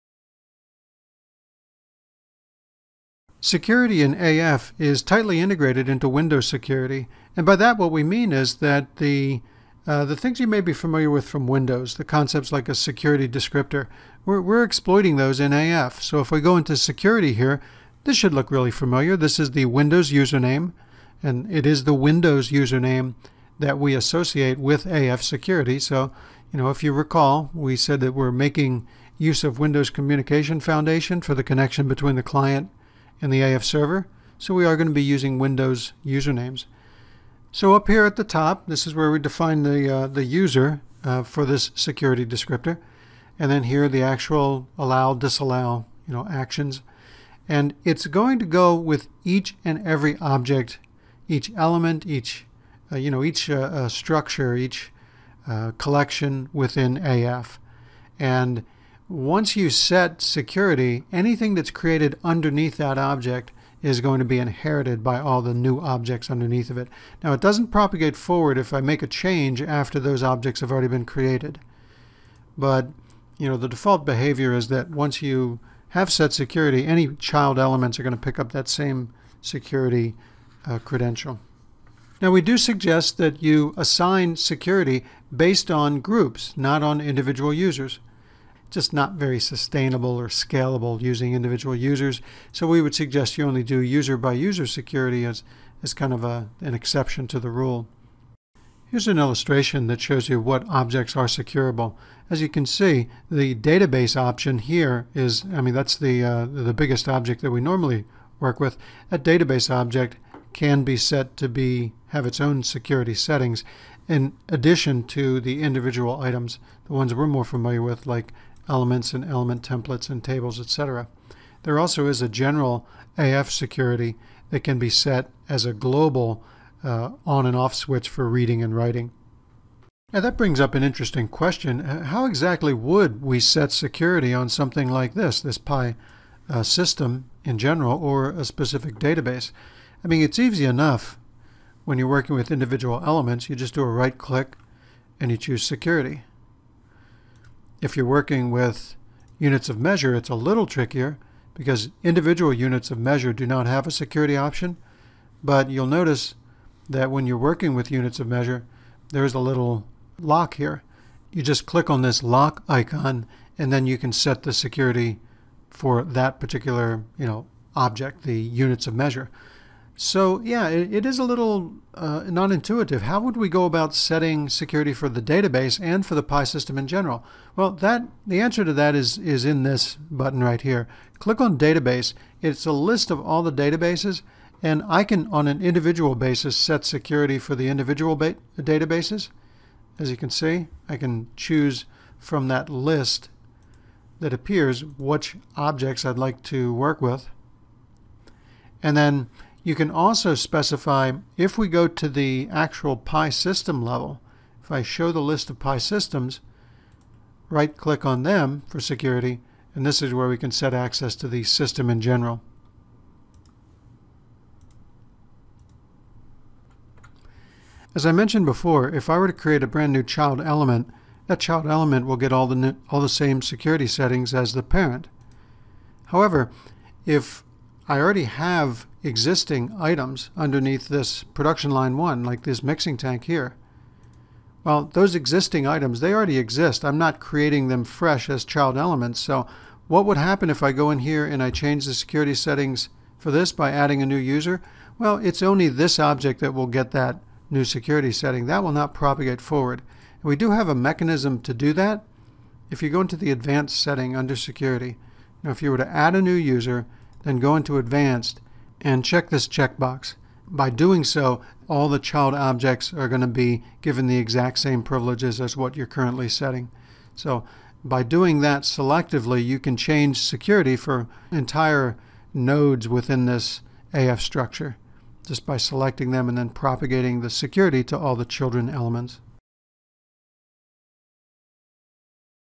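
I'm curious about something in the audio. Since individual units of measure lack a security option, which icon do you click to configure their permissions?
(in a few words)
Lock icon.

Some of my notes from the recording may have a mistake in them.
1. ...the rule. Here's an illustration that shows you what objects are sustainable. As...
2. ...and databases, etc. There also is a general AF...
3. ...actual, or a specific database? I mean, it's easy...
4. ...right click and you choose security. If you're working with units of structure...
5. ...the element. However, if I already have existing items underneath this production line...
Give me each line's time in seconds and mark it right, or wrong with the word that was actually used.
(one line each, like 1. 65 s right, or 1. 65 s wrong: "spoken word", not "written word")
1. 97 s wrong: "secureable", not "sustainable"
2. 120 s wrong: "tables", not "databases"
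3. 137 s wrong: "general", not "actual"
4. 143 s wrong: "measure", not "structure"
5. 224 s wrong: "parent", not "element".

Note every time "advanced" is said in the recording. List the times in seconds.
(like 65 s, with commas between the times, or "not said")
253 s, 257 s.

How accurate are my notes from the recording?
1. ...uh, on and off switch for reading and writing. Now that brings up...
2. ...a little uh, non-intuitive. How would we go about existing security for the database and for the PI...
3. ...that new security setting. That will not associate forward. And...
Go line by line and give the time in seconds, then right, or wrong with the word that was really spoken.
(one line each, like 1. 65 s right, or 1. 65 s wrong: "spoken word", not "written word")
1. 126 s right
2. 171 s wrong: "setting", not "existing"
3. 246 s wrong: "propagate", not "associate".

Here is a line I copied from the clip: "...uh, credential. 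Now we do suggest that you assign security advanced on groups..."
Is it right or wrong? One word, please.
wrong.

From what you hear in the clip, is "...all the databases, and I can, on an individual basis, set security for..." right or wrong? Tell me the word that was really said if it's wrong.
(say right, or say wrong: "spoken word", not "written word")
right.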